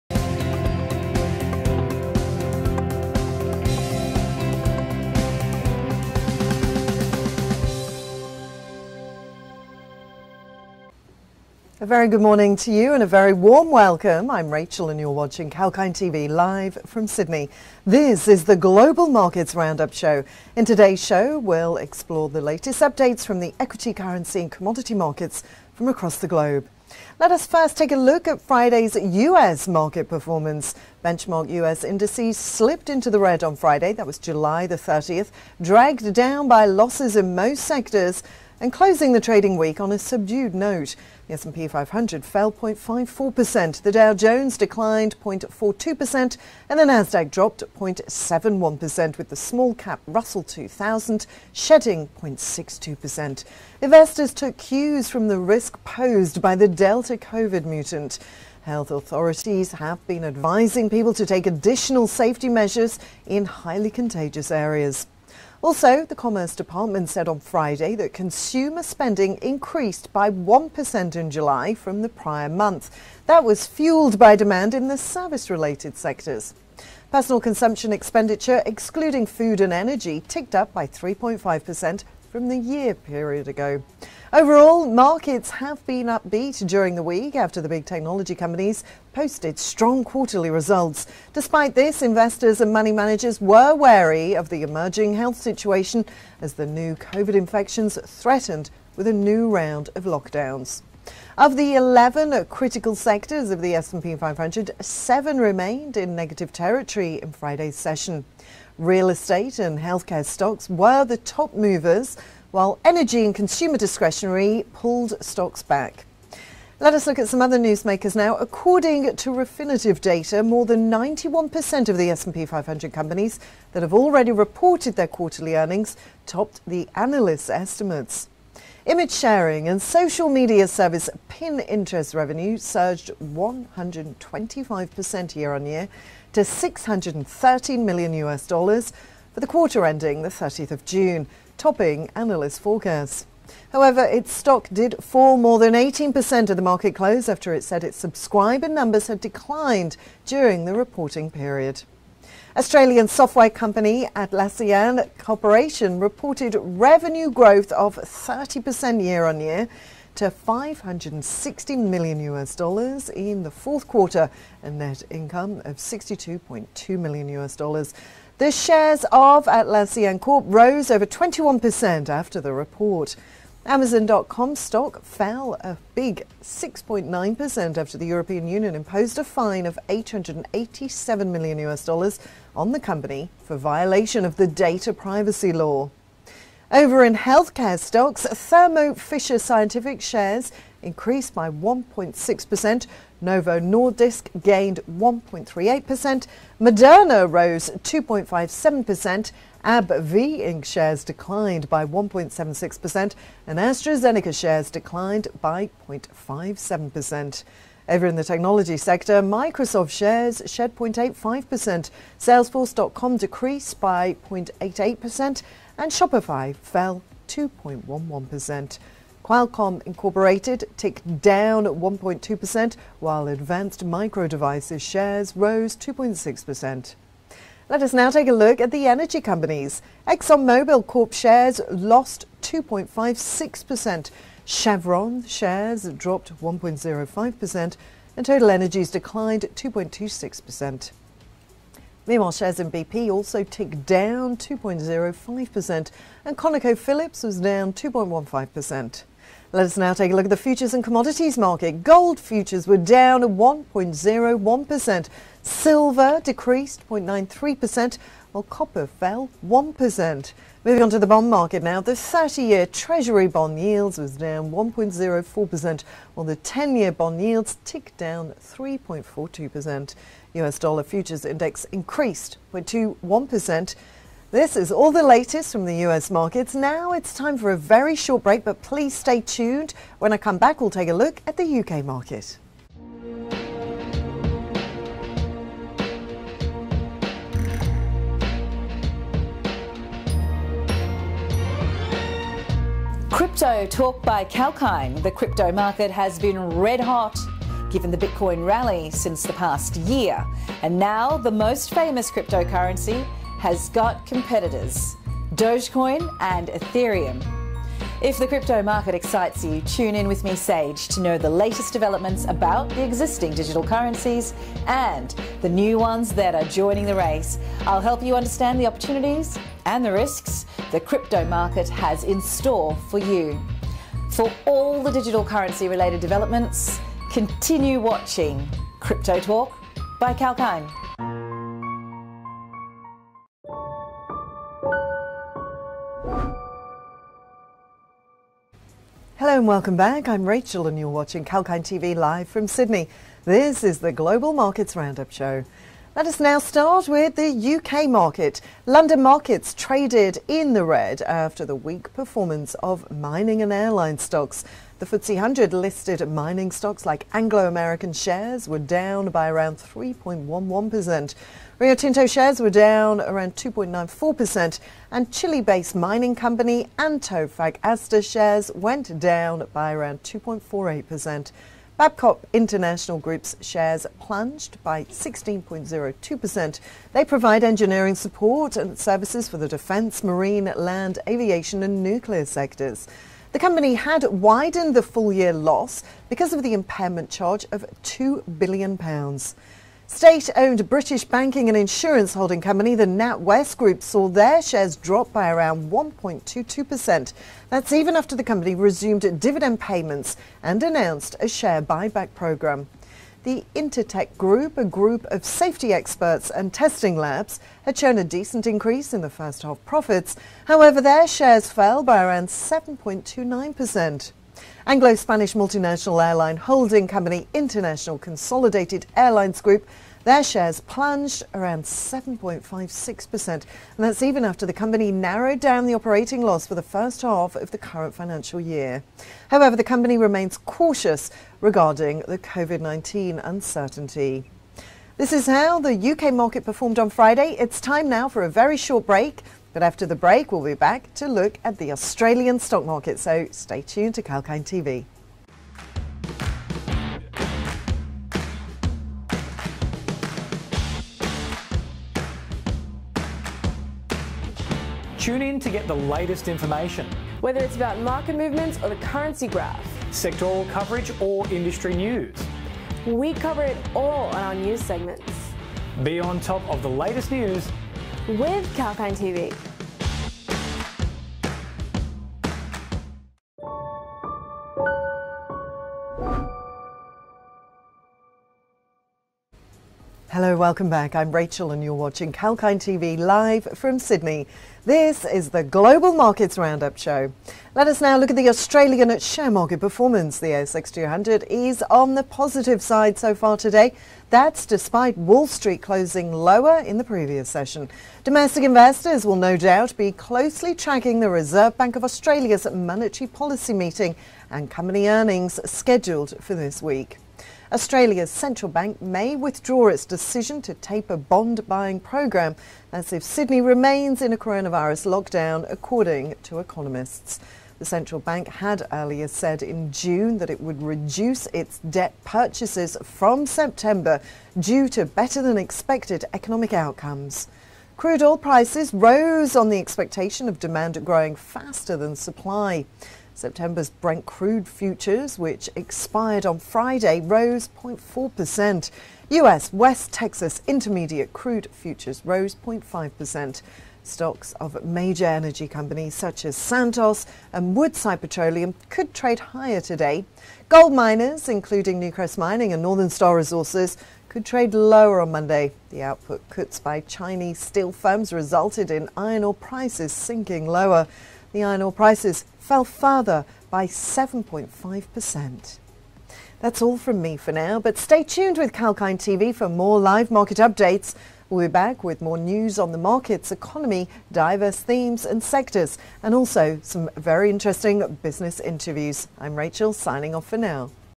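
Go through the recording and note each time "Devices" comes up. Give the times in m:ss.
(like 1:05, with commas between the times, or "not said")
3:44.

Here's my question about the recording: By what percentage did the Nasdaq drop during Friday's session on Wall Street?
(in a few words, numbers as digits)
0.71%.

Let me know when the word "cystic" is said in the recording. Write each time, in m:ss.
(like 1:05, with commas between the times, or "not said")
not said.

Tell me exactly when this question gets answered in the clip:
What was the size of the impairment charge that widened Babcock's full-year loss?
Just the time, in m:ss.
6:27.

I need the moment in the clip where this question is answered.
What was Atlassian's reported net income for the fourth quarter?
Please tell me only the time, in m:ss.
2:45.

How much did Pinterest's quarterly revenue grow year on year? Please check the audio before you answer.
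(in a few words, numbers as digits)
125%.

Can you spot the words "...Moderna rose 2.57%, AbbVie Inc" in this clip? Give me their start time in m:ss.
3:16.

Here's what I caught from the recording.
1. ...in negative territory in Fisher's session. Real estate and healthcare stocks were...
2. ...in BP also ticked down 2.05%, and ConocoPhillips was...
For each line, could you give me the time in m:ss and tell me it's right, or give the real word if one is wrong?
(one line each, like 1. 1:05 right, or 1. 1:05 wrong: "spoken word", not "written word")
1. 1:45 wrong: "Friday", not "Fisher"
2. 4:02 right.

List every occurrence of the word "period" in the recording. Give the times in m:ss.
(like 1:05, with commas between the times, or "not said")
1:22, 2:31.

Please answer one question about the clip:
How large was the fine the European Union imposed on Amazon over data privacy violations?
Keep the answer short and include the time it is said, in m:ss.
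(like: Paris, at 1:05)
887 million US dollars, at 2:59.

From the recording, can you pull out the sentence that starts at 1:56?
Let us look at some other newsmakers now.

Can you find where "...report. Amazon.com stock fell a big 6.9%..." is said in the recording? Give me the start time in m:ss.
2:52.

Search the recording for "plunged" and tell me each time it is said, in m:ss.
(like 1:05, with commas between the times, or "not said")
6:13, 7:00.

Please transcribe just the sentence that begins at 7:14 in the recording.
This is how the UK market performed on Friday.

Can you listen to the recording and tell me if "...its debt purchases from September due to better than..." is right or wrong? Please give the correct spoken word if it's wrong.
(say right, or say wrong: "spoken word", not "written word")
right.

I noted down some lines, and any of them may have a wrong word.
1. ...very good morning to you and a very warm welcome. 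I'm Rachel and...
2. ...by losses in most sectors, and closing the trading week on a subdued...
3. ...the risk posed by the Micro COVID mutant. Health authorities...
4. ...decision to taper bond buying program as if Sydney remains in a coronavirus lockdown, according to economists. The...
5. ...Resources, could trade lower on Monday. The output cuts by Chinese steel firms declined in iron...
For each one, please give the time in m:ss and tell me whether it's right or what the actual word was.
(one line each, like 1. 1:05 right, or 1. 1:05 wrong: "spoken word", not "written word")
1. 0:11 right
2. 0:36 right
3. 0:55 wrong: "Delta", not "Micro"
4. 8:29 right
5. 9:13 wrong: "resulted", not "declined".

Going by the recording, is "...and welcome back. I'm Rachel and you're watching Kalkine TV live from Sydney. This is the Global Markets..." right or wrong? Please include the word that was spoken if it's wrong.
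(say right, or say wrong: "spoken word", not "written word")
right.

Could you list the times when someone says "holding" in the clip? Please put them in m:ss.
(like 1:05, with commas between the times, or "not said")
6:32, 6:56.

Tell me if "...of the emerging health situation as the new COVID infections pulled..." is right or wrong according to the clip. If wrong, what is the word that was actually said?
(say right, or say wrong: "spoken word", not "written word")
wrong: "threatened", not "pulled".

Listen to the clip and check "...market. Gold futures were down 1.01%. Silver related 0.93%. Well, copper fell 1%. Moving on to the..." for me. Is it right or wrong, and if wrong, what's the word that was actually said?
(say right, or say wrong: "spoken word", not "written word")
wrong: "decreased", not "related".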